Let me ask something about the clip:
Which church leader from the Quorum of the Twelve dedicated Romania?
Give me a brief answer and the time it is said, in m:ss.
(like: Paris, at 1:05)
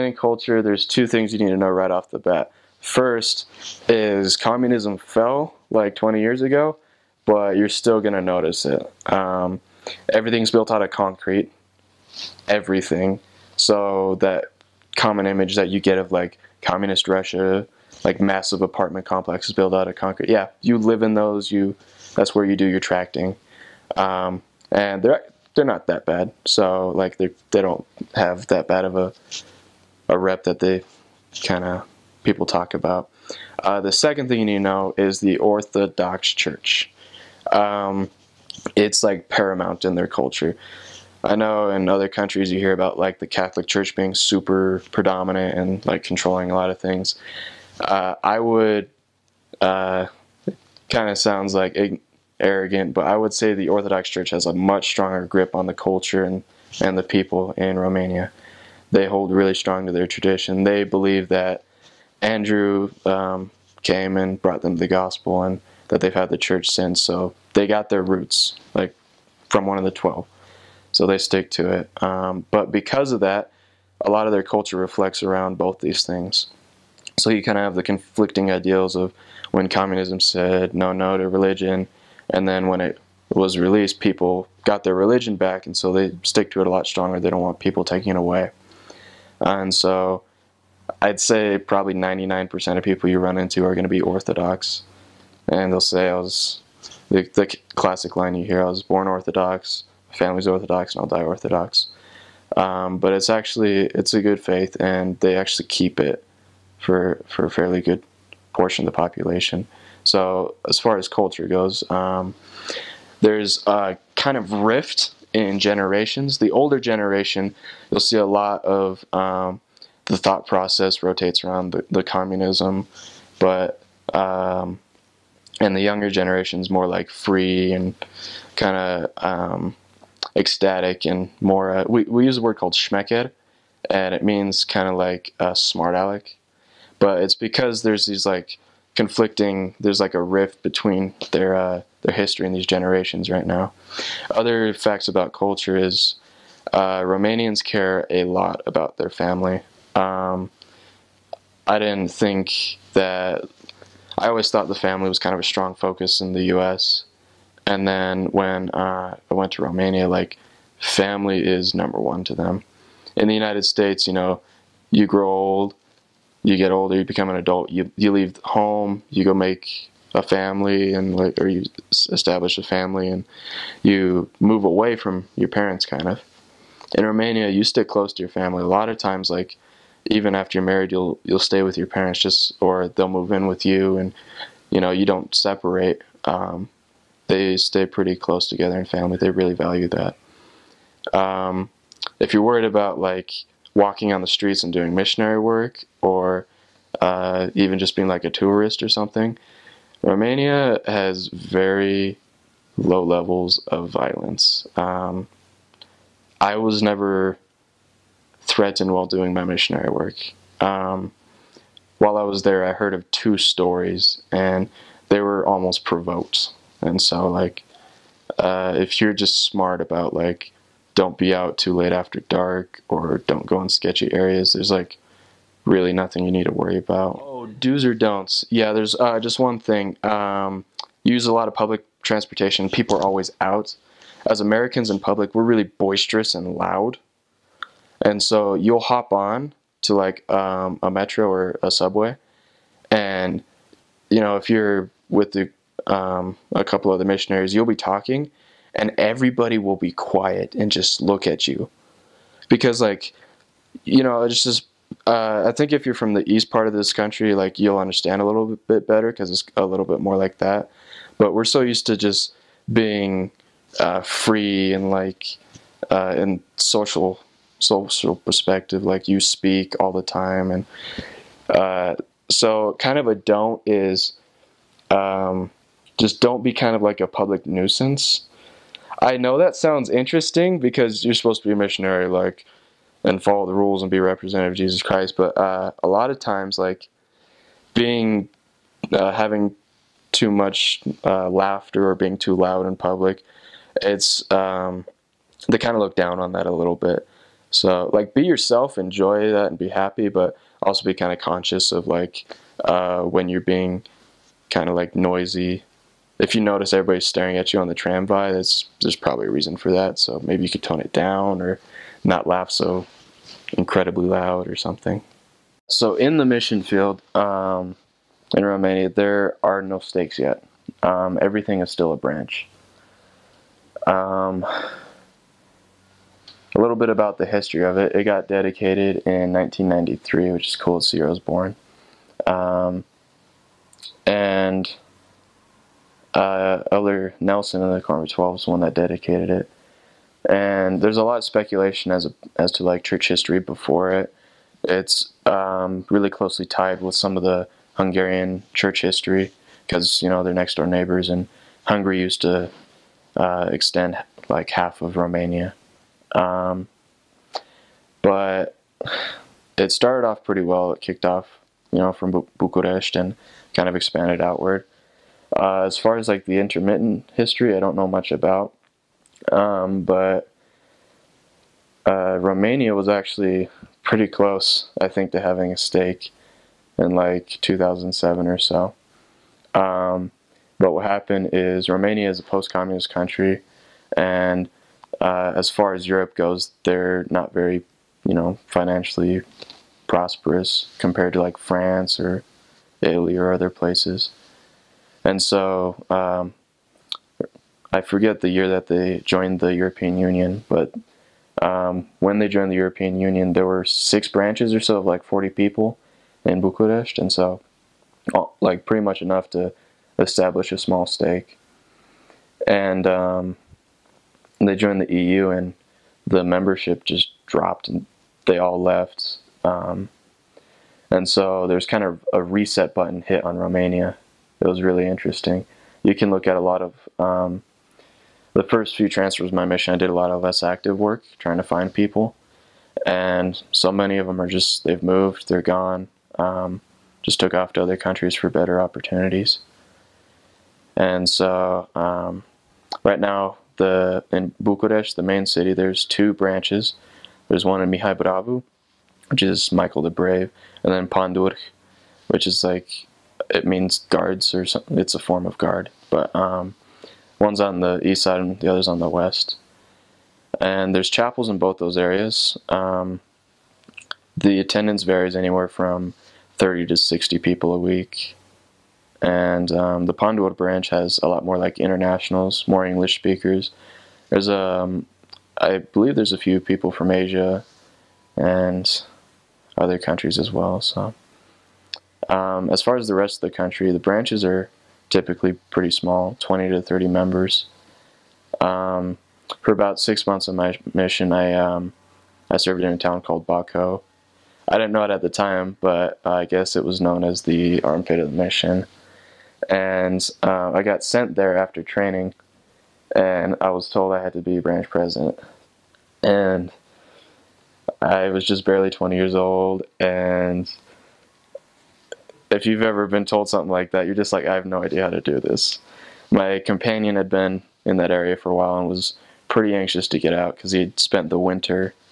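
Elder Nelson, at 5:36.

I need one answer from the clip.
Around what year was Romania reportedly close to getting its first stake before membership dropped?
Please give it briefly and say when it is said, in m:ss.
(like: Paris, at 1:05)
2007, at 6:17.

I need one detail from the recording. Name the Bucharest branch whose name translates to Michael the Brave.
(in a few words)
Mihai Bravu.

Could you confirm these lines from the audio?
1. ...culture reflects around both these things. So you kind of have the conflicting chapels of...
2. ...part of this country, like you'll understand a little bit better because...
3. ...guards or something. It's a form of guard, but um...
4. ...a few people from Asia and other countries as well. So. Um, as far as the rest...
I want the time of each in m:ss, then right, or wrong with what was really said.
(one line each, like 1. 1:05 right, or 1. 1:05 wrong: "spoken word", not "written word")
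1. 1:14 wrong: "ideals", not "chapels"
2. 4:16 right
3. 7:33 right
4. 7:56 right.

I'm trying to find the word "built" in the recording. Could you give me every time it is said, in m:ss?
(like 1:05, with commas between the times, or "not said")
0:10, 0:19.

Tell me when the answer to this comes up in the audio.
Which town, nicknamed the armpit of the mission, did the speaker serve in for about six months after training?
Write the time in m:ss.
8:13.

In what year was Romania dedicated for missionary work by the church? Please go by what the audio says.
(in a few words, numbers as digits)
1993.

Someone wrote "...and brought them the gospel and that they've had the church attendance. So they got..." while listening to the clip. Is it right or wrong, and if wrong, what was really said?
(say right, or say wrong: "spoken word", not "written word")
wrong: "since", not "attendance".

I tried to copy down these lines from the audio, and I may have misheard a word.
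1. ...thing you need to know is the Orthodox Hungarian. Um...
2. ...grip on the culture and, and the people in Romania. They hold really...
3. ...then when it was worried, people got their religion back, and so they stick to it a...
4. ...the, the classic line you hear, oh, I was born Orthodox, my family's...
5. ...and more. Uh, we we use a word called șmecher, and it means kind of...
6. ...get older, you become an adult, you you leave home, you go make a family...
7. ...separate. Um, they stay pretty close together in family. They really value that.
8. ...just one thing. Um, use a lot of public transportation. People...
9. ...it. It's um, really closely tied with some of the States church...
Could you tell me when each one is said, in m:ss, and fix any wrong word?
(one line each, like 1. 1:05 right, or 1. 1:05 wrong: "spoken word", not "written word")
1. 0:34 wrong: "Church", not "Hungarian"
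2. 0:55 right
3. 1:22 wrong: "released", not "worried"
4. 1:37 right
5. 2:11 right
6. 2:46 right
7. 3:05 right
8. 3:49 right
9. 5:43 wrong: "Hungarian", not "States".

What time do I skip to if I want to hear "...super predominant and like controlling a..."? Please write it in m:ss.
0:44.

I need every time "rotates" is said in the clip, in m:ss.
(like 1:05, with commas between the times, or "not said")
2:01.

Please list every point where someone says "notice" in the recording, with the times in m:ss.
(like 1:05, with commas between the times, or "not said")
0:08, 5:06.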